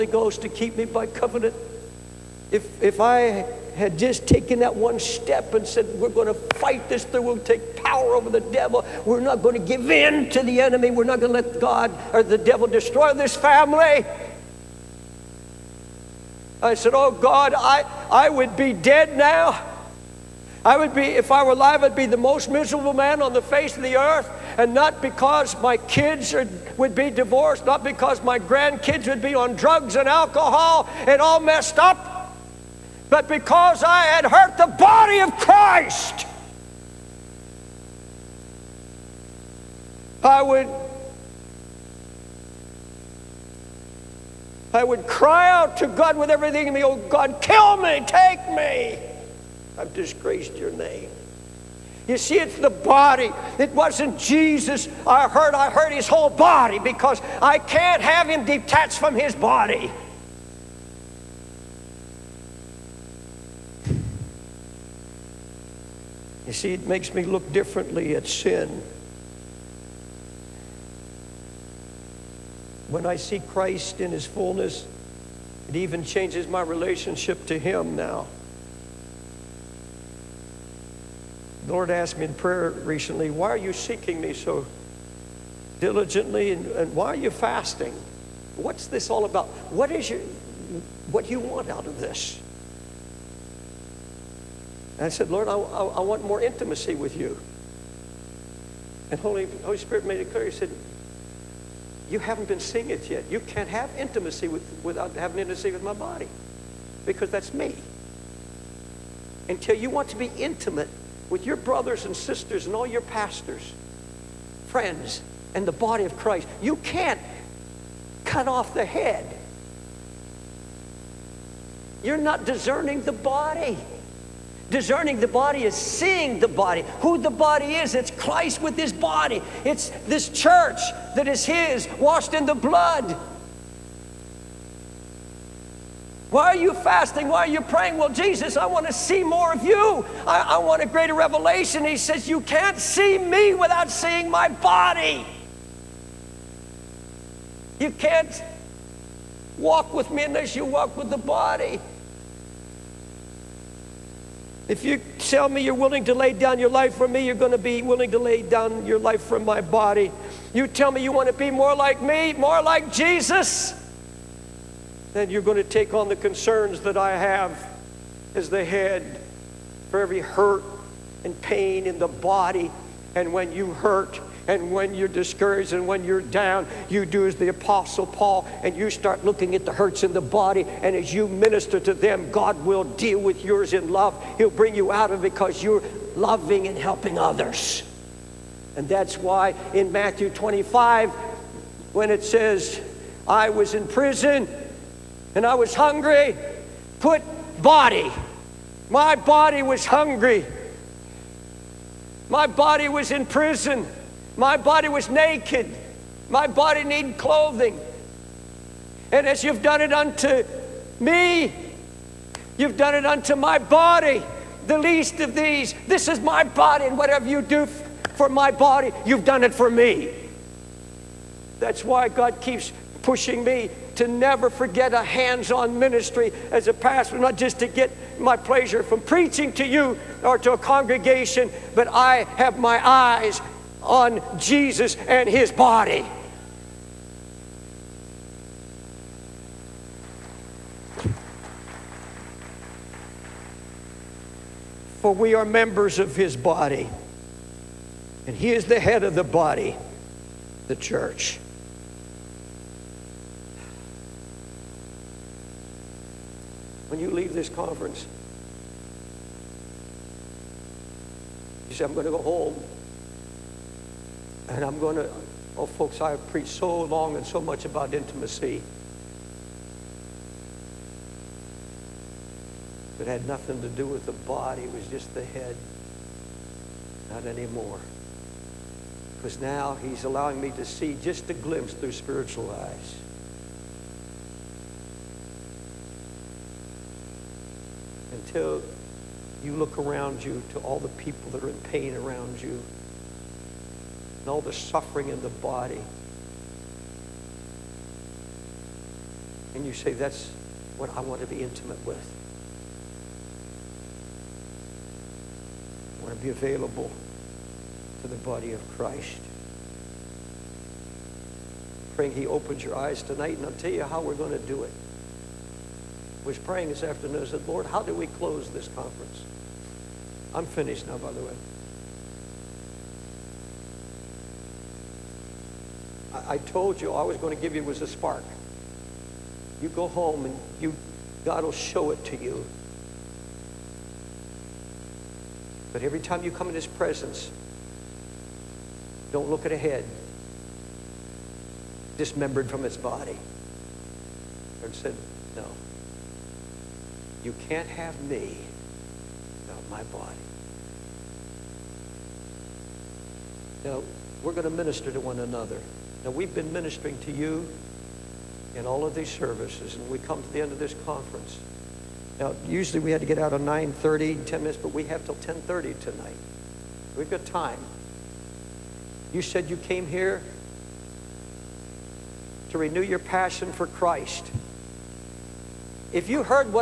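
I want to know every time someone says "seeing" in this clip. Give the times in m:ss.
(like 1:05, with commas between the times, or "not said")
1:42, 2:05, 2:23.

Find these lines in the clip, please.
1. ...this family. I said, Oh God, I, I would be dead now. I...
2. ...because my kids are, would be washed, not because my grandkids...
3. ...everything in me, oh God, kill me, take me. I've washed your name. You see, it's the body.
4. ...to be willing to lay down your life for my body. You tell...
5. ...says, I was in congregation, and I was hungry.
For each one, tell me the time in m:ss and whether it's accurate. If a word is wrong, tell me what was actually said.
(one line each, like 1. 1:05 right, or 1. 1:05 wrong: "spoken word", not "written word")
1. 0:13 right
2. 0:25 wrong: "divorced", not "washed"
3. 0:46 wrong: "disgraced", not "washed"
4. 2:37 right
5. 3:12 wrong: "prison", not "congregation".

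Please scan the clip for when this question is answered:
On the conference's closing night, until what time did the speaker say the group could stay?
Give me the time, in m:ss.
6:05.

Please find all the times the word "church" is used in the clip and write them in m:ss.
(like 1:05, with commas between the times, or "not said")
2:10, 4:10.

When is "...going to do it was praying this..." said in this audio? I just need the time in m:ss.
5:14.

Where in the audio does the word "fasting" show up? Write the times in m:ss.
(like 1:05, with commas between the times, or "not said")
1:27, 2:16.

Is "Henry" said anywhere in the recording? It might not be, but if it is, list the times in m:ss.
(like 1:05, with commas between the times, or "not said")
not said.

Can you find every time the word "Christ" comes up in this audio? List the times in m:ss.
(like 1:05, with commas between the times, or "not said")
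0:35, 1:13, 1:56, 2:08, 5:08, 6:13.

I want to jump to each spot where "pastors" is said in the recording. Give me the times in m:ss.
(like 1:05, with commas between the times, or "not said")
1:53, 3:46.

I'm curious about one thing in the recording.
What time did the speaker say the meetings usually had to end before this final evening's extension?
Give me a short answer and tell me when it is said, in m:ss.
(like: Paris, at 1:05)
9:30, at 6:03.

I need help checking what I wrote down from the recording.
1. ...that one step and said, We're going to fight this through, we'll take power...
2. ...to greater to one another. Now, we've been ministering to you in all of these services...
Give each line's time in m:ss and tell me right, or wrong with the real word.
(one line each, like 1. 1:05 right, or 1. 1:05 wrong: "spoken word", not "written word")
1. 0:04 right
2. 5:54 wrong: "minister", not "greater".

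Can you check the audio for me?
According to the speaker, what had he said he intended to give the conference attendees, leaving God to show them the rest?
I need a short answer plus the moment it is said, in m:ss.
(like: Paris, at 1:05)
A spark, at 5:27.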